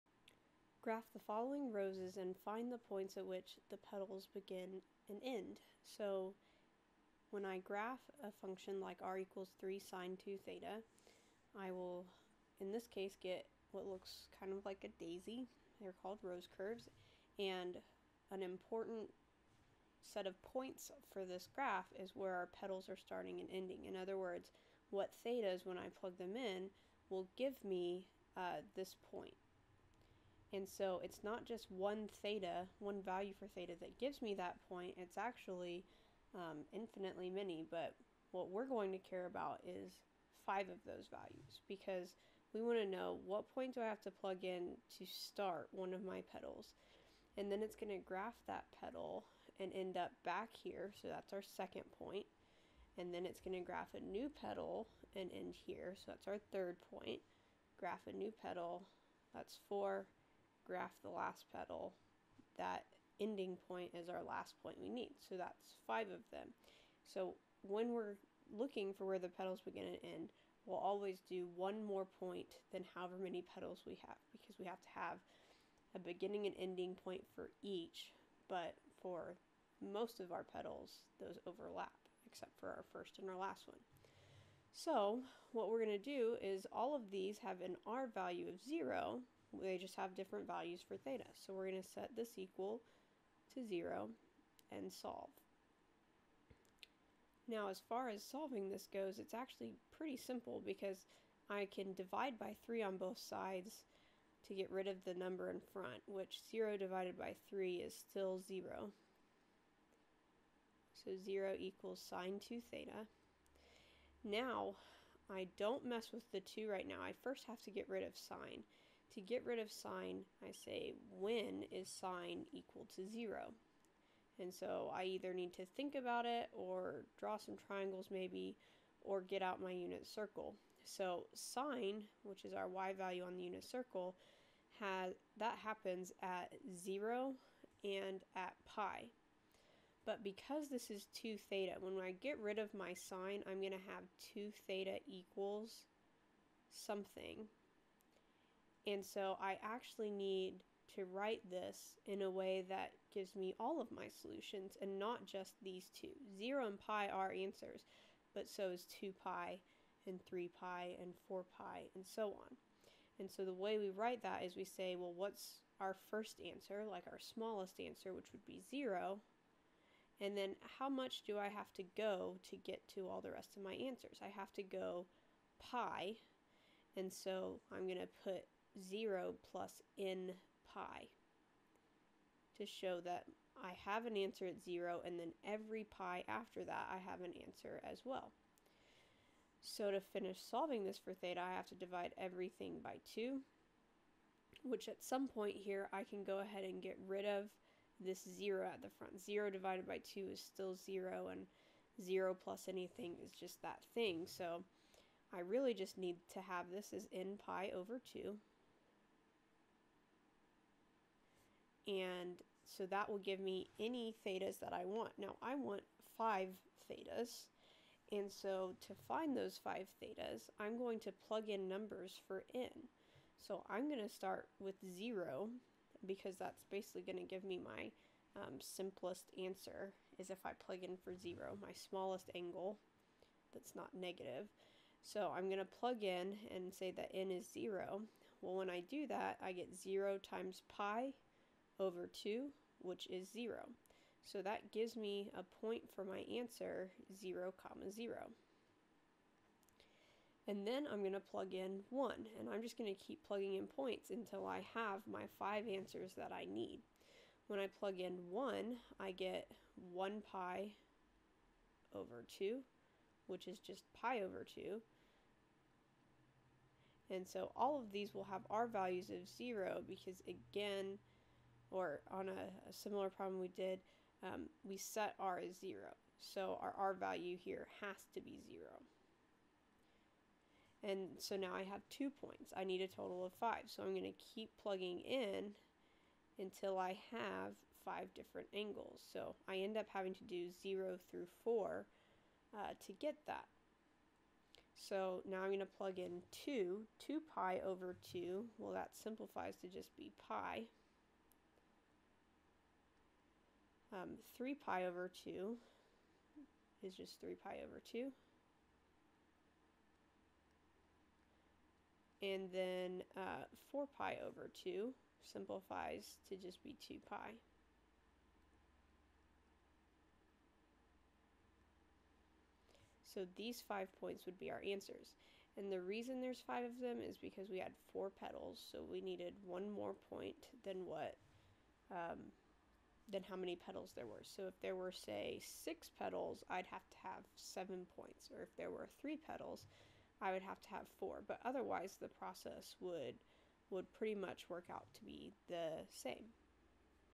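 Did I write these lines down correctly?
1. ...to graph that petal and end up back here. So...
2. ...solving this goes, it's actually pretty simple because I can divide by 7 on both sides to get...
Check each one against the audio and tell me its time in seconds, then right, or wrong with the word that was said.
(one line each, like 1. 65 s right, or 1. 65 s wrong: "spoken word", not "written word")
1. 47 s right
2. 98 s wrong: "3", not "7".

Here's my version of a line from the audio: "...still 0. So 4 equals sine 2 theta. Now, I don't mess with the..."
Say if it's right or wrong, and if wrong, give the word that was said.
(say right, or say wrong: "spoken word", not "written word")
wrong: "0", not "4".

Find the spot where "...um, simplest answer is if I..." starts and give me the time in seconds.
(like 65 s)
228 s.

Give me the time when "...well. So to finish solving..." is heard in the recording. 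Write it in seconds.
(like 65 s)
188 s.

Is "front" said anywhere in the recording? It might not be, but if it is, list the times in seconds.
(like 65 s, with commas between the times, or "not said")
105 s, 198 s.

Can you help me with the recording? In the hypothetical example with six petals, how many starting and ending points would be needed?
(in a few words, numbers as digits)
7.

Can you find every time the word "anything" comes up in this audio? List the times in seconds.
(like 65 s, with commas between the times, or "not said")
202 s.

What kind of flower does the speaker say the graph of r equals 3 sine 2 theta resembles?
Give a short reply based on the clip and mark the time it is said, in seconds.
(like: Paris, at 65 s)
daisy, at 15 s.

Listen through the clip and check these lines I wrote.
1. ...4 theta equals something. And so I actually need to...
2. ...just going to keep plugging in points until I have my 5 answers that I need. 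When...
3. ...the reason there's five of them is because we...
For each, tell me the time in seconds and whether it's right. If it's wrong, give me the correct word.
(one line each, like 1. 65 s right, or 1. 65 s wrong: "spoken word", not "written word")
1. 144 s wrong: "2", not "4"
2. 252 s right
3. 325 s right.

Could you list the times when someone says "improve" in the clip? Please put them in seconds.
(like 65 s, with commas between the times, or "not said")
not said.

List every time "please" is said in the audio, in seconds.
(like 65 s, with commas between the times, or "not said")
not said.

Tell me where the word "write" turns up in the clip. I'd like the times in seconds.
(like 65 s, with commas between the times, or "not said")
151 s, 163 s.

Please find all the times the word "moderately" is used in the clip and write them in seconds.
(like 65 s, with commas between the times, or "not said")
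not said.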